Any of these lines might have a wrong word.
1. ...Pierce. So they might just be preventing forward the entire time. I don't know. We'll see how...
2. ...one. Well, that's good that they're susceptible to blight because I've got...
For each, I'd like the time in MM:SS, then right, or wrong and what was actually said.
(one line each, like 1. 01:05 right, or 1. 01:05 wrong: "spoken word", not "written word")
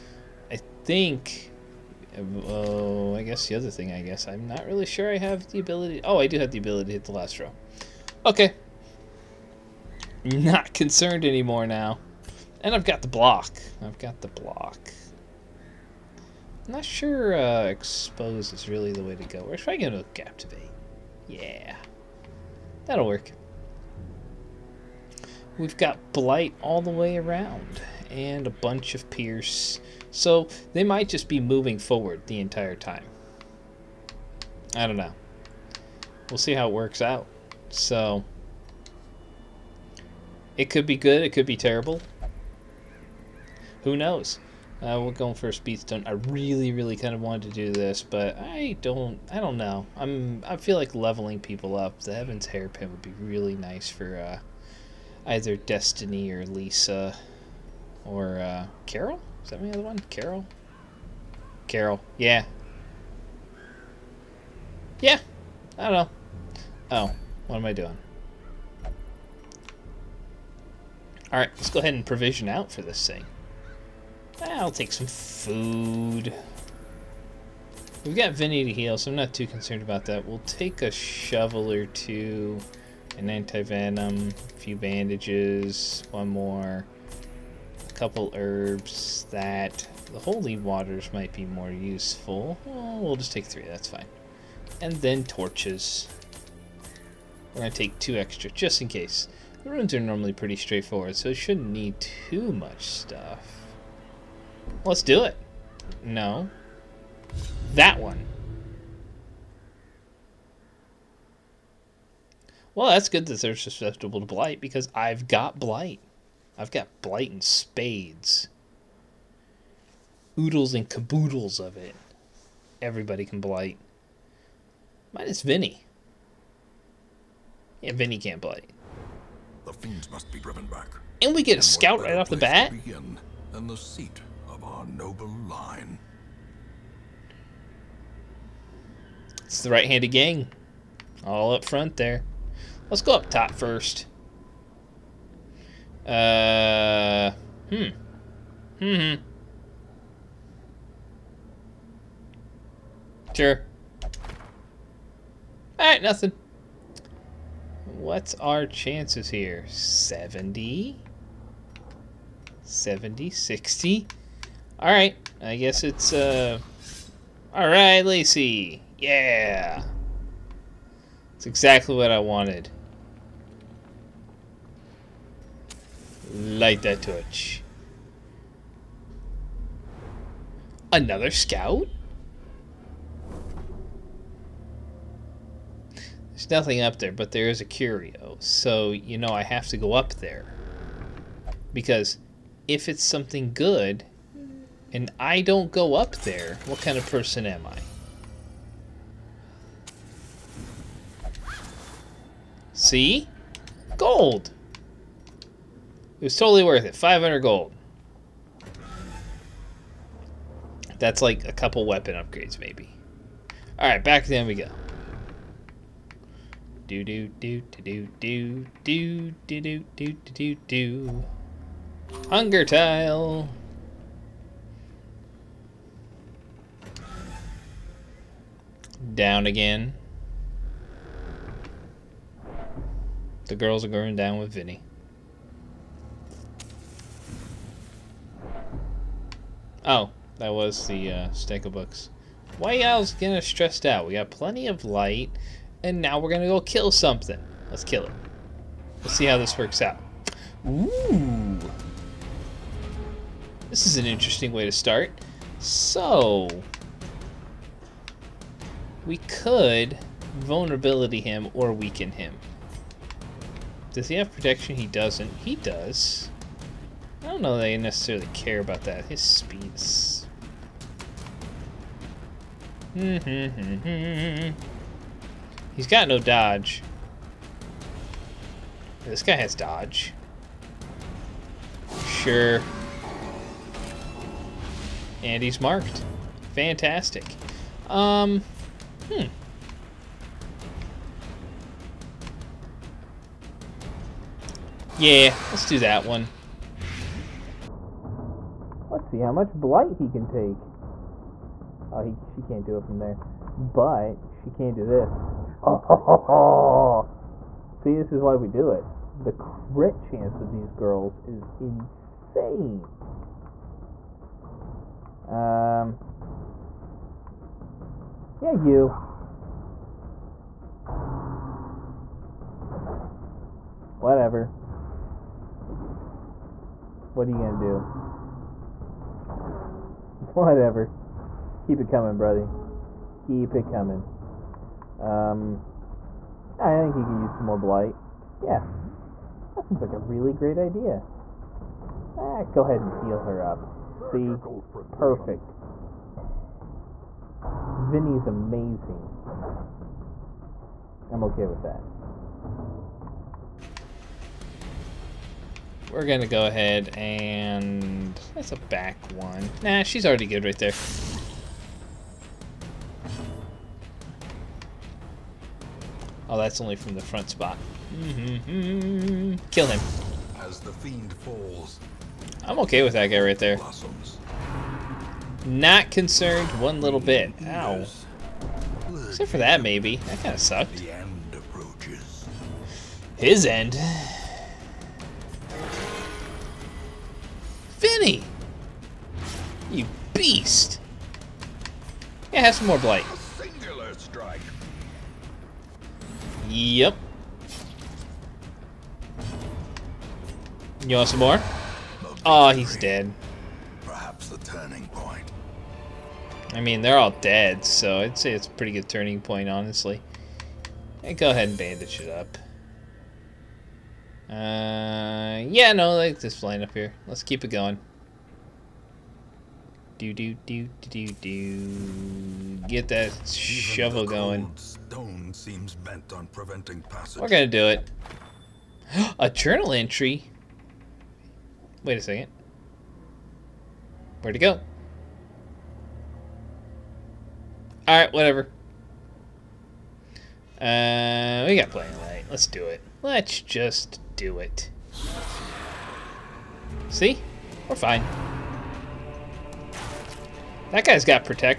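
1. 00:29 wrong: "moving", not "preventing"
2. 01:47 right.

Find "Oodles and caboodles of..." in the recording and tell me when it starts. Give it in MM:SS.
02:00.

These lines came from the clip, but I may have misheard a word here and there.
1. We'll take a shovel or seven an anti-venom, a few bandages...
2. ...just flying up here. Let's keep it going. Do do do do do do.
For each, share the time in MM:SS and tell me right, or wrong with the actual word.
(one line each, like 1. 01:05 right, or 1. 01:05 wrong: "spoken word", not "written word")
1. 01:20 wrong: "two", not "seven"
2. 06:56 right.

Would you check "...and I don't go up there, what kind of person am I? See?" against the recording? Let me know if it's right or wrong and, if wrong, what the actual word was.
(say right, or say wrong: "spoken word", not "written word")
right.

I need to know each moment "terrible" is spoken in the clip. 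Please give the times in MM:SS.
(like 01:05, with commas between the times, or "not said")
00:41.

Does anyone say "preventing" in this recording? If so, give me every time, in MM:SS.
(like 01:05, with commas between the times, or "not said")
07:06.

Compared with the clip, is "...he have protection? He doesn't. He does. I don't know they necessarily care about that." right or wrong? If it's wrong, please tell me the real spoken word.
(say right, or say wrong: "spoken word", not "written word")
right.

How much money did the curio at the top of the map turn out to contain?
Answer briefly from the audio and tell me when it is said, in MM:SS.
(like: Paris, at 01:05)
500 gold, at 03:26.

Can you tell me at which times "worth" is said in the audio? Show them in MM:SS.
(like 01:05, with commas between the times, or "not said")
03:26.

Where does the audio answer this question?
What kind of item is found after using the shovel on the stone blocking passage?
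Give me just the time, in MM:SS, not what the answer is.
07:09.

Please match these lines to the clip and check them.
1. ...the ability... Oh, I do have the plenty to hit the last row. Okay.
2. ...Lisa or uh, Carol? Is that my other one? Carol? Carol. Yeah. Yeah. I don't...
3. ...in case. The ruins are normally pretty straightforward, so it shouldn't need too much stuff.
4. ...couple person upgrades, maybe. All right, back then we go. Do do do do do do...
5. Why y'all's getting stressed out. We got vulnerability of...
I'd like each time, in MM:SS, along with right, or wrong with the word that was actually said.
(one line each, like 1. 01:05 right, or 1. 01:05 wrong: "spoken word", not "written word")
1. 00:05 wrong: "ability", not "plenty"
2. 00:56 right
3. 01:38 right
4. 03:31 wrong: "weapon", not "person"
5. 04:02 wrong: "plenty", not "vulnerability".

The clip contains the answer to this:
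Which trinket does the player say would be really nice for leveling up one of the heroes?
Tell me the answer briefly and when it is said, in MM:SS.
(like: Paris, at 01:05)
Heaven's hairpin, at 00:52.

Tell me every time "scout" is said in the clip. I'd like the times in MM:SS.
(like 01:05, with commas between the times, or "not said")
02:11, 03:01.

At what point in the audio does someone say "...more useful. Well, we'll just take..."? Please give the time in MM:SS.
01:31.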